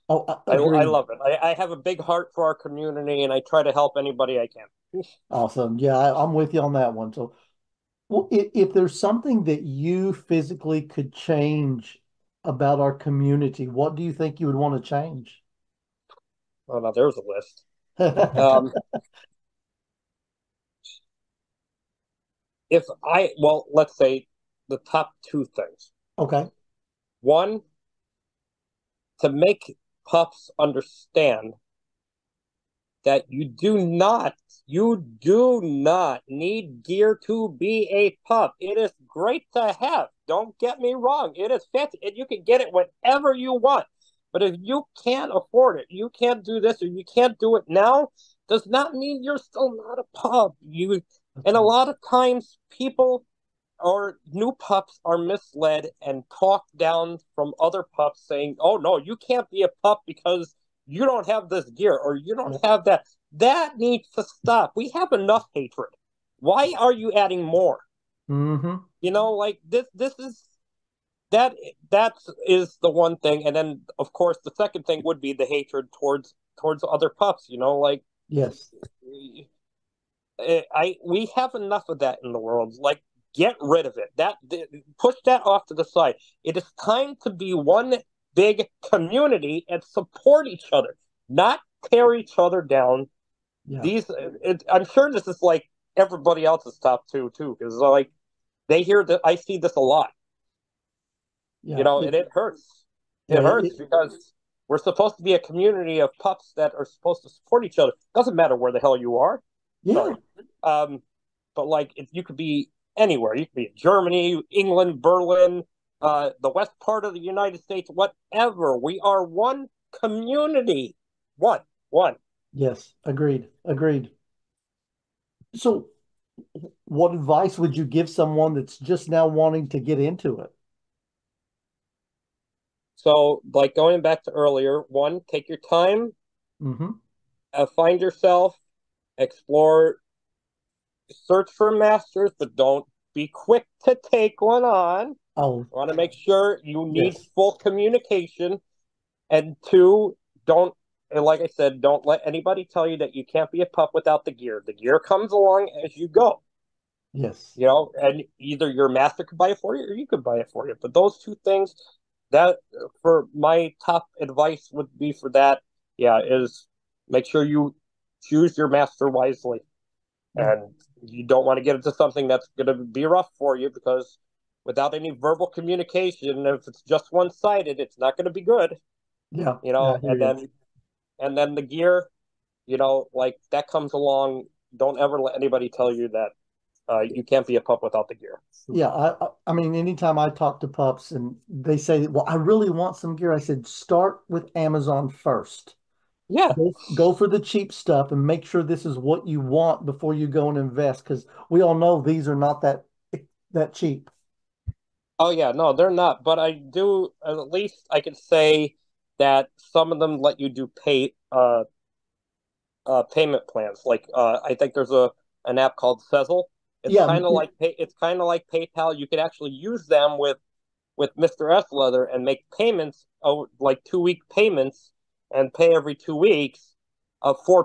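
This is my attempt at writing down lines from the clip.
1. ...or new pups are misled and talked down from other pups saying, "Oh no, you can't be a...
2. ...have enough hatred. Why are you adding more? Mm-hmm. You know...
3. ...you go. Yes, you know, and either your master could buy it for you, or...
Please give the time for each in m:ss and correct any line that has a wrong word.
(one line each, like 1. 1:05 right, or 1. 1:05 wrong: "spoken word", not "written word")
1. 0:53 right
2. 1:04 right
3. 2:35 right.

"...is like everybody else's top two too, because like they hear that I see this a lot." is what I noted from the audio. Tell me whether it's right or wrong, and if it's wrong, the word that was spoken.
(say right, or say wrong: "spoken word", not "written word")
right.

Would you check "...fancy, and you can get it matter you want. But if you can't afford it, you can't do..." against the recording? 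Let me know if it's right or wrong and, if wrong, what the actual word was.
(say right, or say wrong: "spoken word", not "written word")
wrong: "whenever", not "matter".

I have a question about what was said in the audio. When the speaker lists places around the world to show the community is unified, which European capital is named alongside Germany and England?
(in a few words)
Berlin.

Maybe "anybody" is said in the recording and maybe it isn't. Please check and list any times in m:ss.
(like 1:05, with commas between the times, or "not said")
0:03, 2:32, 3:05.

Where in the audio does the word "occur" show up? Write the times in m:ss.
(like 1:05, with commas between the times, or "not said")
not said.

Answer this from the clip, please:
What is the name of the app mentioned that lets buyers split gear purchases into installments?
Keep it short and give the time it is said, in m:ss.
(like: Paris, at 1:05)
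Sezzle, at 3:36.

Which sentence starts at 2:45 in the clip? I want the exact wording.
Yeah, is make sure you choose your master wisely, mm-hmm.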